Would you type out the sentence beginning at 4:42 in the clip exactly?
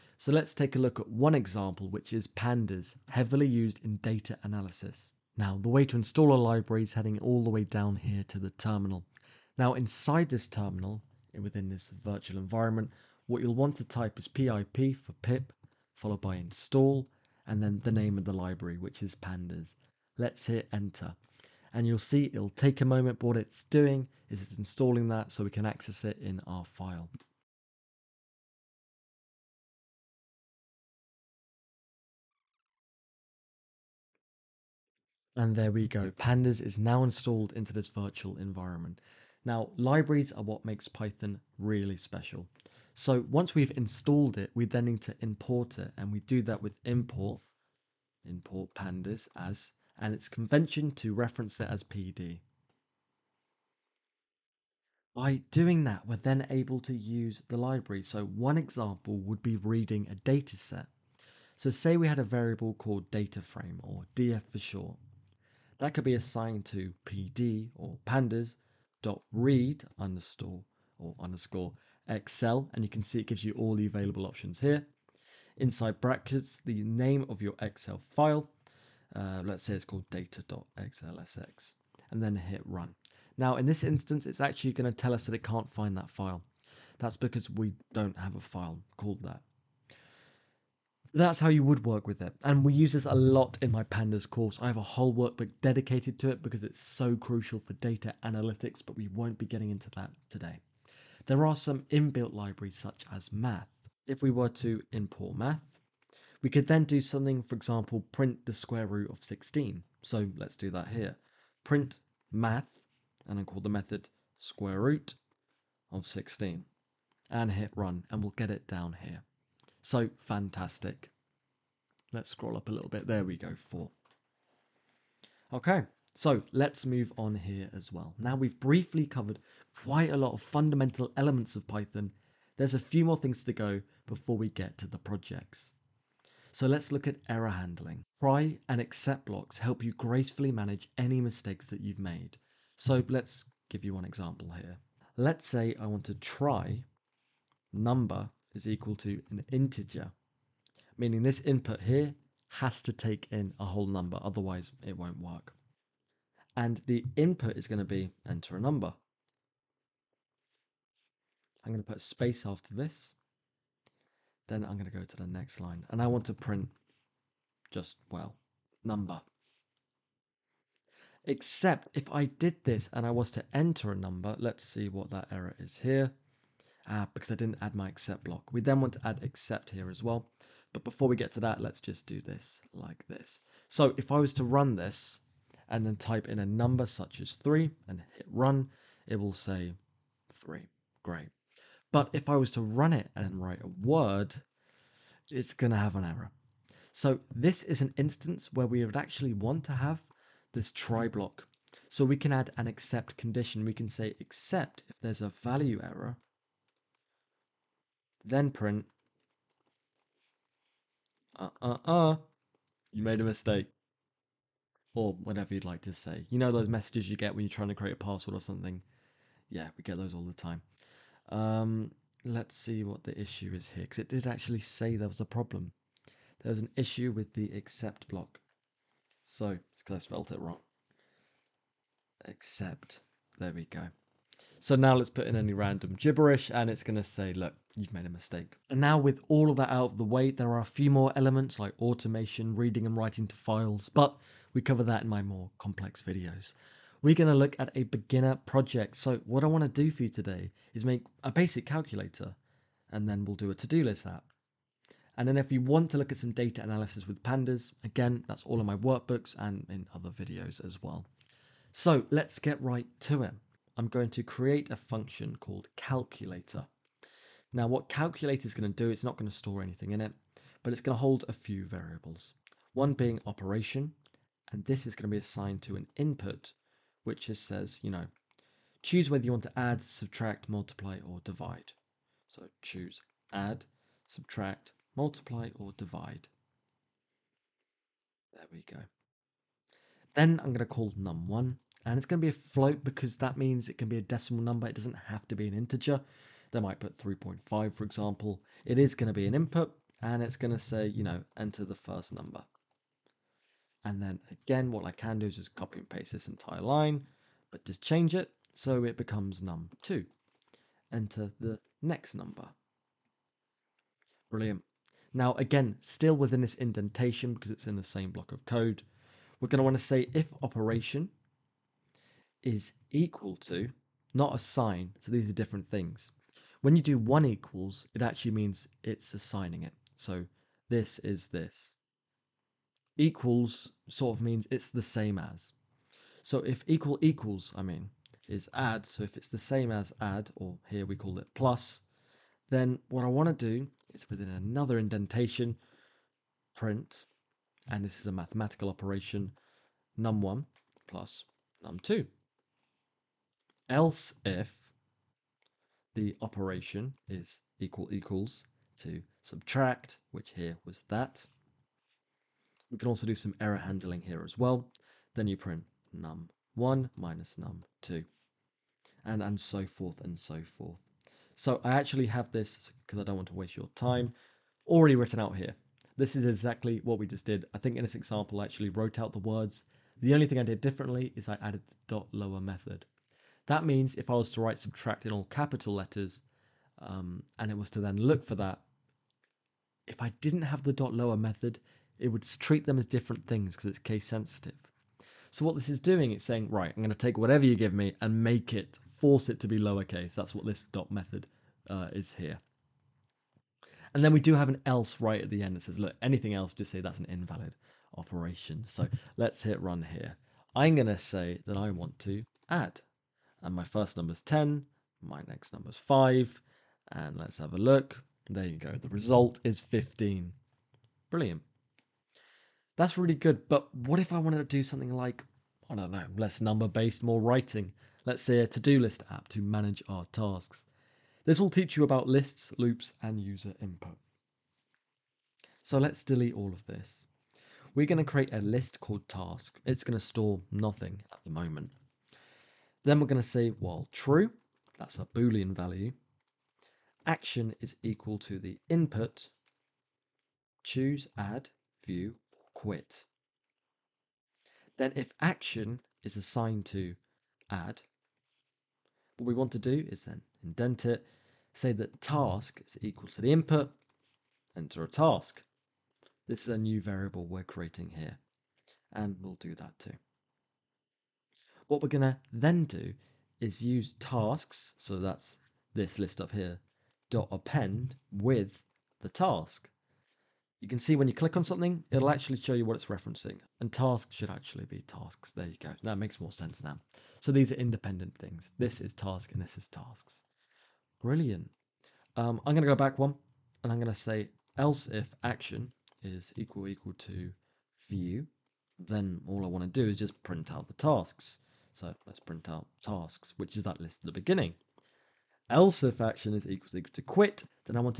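So choose add, subtract, multiply, or divide.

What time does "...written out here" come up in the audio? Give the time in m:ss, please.
6:14.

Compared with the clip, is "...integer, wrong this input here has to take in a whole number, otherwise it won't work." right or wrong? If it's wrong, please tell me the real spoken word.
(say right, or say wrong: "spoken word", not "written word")
wrong: "meaning", not "wrong".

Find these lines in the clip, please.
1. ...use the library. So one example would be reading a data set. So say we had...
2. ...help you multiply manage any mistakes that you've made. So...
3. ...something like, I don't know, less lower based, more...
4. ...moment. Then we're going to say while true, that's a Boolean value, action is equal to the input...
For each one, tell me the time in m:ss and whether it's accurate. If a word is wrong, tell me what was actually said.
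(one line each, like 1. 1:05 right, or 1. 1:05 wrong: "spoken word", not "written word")
1. 0:56 right
2. 2:19 wrong: "gracefully", not "multiply"
3. 7:04 wrong: "number", not "lower"
4. 7:21 right.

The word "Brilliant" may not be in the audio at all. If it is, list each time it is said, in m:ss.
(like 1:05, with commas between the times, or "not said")
5:14, 7:01, 8:11.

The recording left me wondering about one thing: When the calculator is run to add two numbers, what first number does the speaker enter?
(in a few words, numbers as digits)
10.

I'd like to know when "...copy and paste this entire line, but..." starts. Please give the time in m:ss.
5:05.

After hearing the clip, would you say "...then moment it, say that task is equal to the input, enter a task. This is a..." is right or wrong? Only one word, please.
wrong.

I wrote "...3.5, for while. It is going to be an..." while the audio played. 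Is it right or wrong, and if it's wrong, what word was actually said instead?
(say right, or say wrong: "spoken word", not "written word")
wrong: "example", not "while".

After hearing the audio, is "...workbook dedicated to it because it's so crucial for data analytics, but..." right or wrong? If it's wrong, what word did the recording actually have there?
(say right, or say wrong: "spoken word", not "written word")
right.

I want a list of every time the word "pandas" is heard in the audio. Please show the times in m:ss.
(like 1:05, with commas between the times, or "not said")
0:02, 0:19, 0:36, 0:48, 1:08, 1:33, 4:17.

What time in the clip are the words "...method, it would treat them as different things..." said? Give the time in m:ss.
6:31.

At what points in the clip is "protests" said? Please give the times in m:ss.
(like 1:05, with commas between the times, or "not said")
not said.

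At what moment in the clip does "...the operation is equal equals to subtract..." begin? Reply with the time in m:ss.
5:55.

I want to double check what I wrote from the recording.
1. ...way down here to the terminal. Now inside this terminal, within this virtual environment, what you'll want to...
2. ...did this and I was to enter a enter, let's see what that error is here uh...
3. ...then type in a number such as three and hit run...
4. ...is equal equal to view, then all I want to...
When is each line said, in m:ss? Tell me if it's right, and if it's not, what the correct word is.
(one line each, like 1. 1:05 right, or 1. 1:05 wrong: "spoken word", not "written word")
1. 0:07 right
2. 2:52 wrong: "number", not "enter"
3. 3:05 right
4. 8:16 right.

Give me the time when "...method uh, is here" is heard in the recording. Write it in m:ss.
6:40.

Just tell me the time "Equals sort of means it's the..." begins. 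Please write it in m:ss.
5:32.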